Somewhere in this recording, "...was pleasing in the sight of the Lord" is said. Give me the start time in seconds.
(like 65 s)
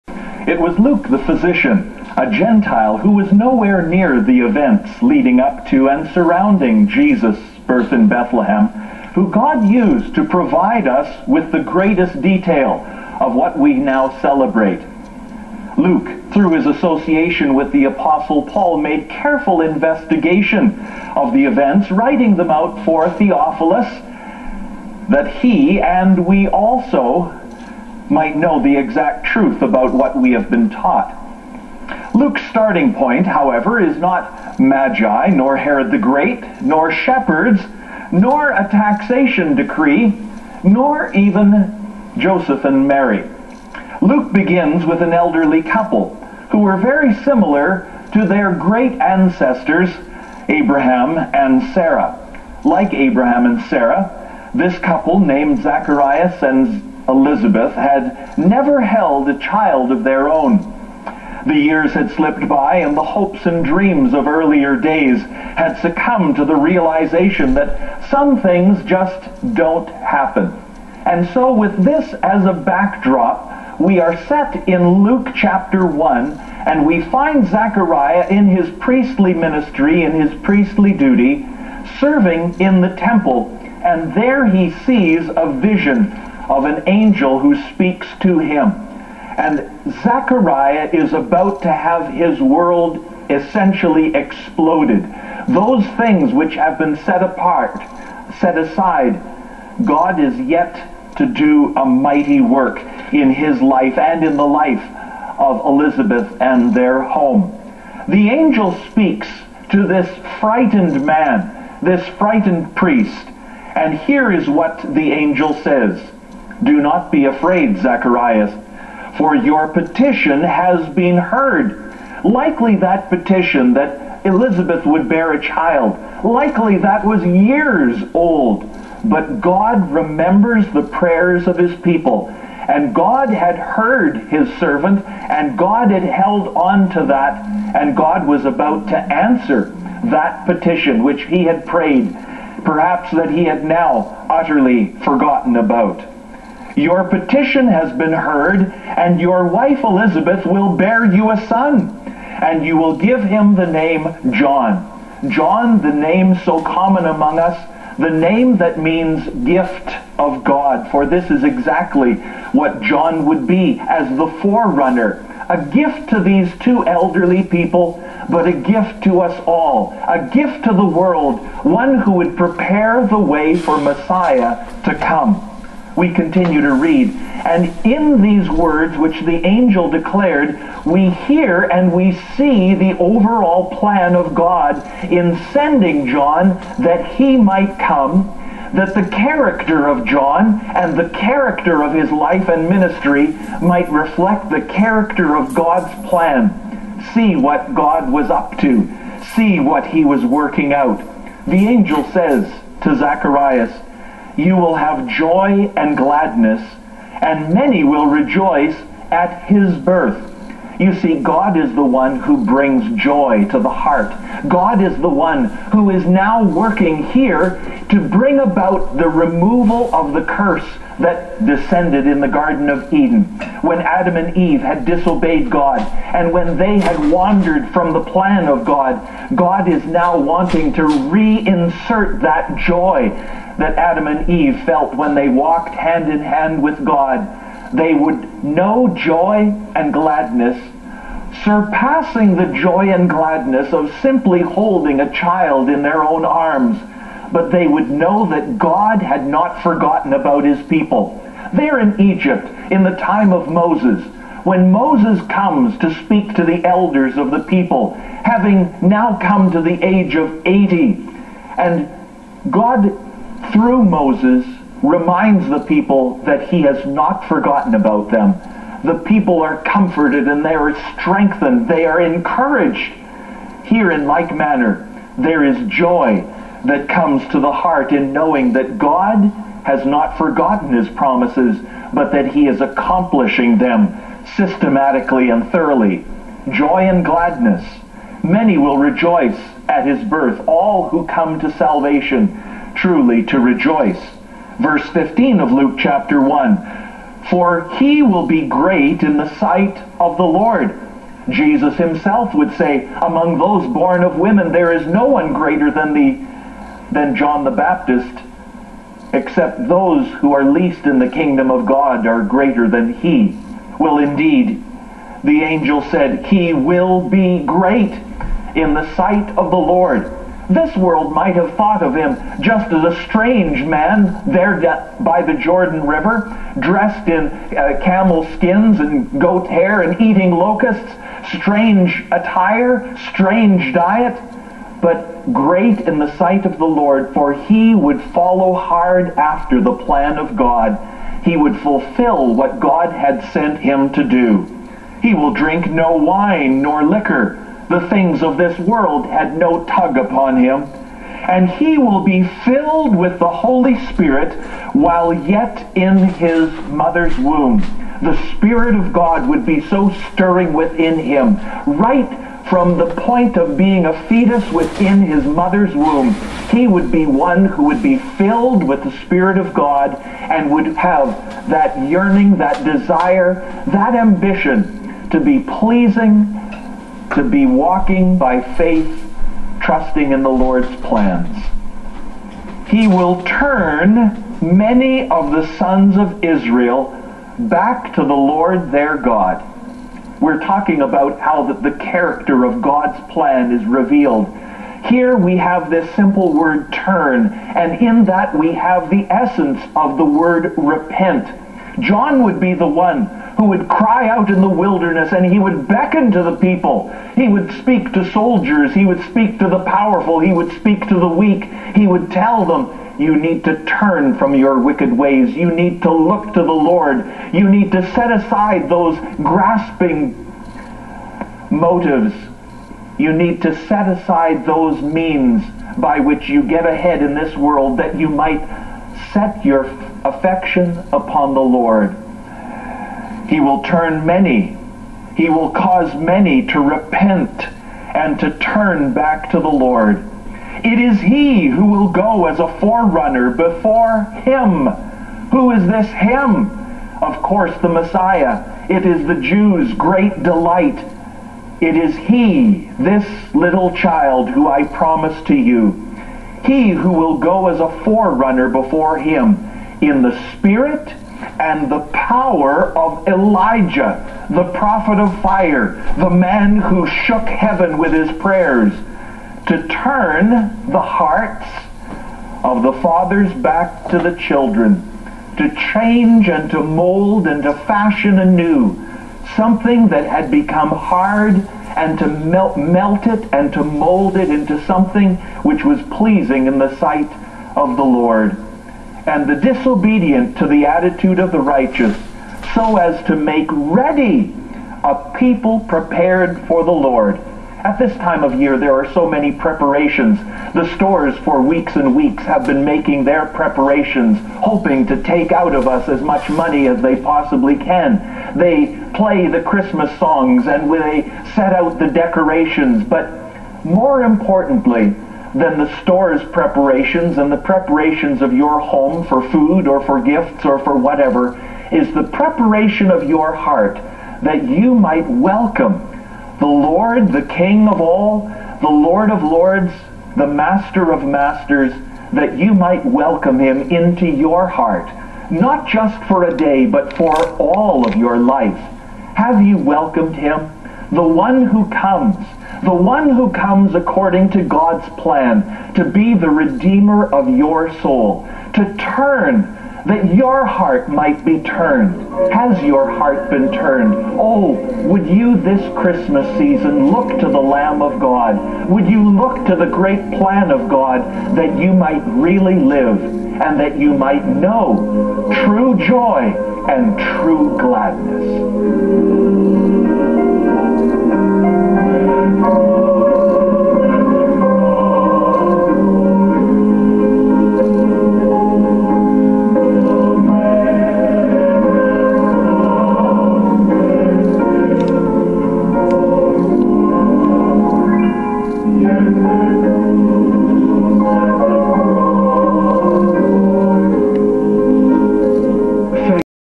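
485 s.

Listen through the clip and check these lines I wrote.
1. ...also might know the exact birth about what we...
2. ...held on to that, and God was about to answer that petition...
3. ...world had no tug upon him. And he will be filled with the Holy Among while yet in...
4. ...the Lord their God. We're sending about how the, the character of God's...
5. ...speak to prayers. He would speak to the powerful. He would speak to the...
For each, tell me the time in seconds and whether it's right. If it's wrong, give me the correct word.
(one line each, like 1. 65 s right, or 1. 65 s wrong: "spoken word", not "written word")
1. 26 s wrong: "truth", not "birth"
2. 136 s right
3. 348 s wrong: "Spirit", not "Among"
4. 388 s wrong: "talking", not "sending"
5. 407 s wrong: "soldiers", not "prayers".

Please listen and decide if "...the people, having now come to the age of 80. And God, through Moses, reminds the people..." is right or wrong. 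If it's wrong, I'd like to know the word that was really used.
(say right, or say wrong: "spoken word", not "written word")
right.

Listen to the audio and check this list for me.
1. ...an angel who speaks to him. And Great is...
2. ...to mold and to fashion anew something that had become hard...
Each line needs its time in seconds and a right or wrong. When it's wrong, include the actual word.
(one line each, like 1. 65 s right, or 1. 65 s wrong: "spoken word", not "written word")
1. 86 s wrong: "Zechariah", not "Great"
2. 476 s right.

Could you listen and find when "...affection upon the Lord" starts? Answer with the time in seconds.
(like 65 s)
430 s.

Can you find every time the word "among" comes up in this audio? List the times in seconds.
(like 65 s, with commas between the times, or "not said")
157 s, 303 s.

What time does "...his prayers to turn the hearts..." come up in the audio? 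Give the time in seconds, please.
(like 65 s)
467 s.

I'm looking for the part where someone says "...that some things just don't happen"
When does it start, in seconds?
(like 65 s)
67 s.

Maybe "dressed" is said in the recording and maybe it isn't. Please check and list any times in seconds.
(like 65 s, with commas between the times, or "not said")
326 s.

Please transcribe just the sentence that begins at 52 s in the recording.
Like Abraham and Sarah, this couple, named Zacharias and Elizabeth, had never held a child of their own.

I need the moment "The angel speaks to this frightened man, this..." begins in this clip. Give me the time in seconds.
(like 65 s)
108 s.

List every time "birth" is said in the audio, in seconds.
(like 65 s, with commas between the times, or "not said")
7 s, 209 s, 290 s.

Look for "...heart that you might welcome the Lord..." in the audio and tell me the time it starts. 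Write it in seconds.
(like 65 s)
523 s.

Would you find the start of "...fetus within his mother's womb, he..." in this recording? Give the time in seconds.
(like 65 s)
364 s.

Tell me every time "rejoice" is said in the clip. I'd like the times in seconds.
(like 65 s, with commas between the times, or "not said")
208 s, 288 s, 293 s.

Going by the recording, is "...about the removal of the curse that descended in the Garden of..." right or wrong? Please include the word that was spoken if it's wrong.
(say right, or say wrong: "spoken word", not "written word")
right.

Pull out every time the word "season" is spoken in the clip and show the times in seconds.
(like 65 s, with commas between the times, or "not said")
556 s.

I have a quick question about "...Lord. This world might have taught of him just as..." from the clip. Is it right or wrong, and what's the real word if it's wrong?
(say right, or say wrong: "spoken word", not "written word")
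wrong: "thought", not "taught".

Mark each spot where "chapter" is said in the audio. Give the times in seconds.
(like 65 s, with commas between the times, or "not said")
75 s, 295 s.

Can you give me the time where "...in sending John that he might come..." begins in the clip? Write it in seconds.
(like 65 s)
185 s.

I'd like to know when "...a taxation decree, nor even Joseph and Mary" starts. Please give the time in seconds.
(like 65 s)
38 s.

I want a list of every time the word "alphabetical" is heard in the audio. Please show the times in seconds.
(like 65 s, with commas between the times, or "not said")
not said.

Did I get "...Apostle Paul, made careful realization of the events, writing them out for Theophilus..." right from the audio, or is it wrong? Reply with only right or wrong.
wrong.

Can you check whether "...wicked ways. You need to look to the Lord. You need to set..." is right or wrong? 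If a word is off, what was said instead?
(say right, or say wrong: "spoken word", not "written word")
right.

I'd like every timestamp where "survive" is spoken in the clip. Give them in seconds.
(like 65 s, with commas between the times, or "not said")
not said.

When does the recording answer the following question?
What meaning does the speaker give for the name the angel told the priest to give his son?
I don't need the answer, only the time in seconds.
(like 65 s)
159 s.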